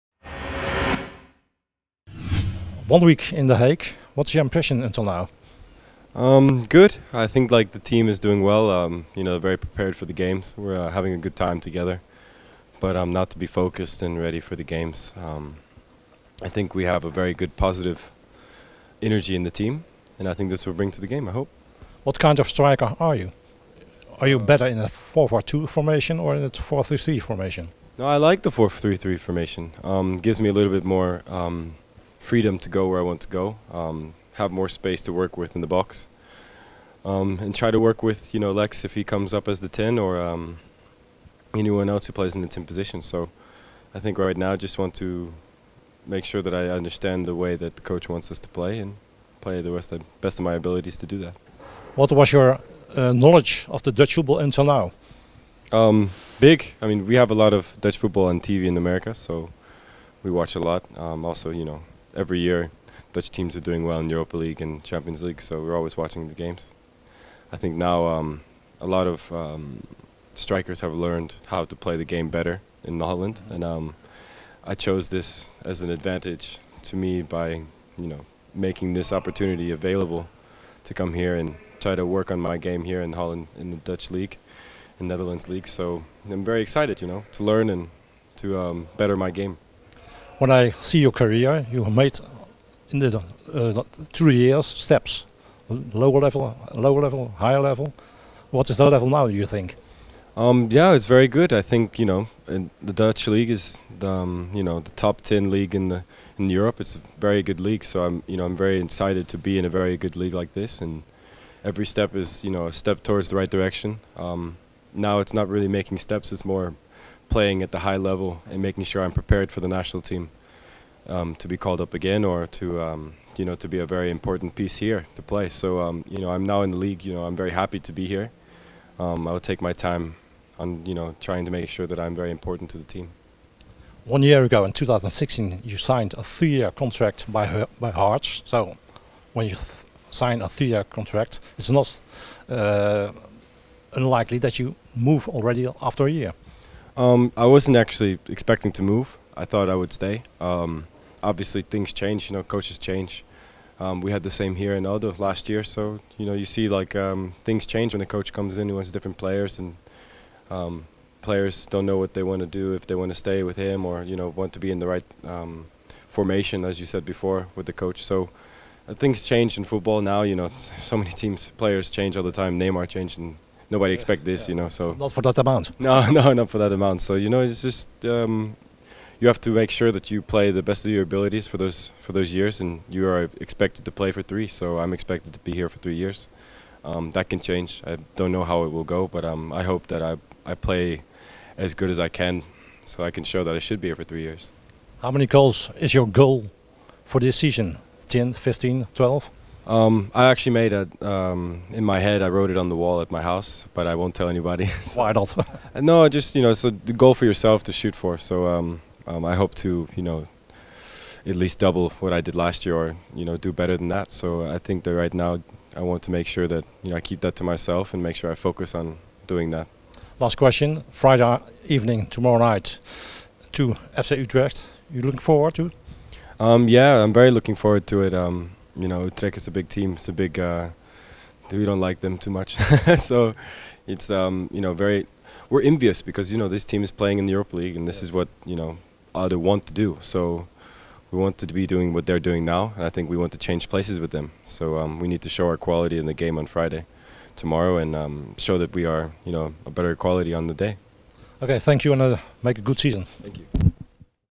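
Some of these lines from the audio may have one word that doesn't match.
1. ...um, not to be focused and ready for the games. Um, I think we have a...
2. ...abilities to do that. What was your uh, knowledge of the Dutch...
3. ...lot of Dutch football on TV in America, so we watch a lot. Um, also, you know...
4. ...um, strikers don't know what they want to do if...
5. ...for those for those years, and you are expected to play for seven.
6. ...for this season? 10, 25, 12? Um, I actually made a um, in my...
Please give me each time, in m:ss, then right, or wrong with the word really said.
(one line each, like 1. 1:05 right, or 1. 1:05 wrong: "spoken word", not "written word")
1. 0:13 right
2. 0:50 right
3. 0:57 right
4. 2:40 wrong: "players", not "strikers"
5. 3:01 wrong: "three", not "seven"
6. 3:17 wrong: "15", not "25".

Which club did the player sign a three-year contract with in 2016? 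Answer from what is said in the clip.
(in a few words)
Hearts.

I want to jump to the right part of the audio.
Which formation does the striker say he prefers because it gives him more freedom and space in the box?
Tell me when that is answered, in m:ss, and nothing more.
0:28.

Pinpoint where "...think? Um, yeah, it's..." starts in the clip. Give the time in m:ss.
1:39.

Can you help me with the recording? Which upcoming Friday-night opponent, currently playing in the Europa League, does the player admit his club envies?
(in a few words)
FC Utrecht.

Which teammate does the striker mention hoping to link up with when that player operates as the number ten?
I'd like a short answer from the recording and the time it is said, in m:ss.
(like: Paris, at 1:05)
Lex, at 0:38.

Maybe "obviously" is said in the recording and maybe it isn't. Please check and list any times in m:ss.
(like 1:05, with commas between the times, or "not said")
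2:31.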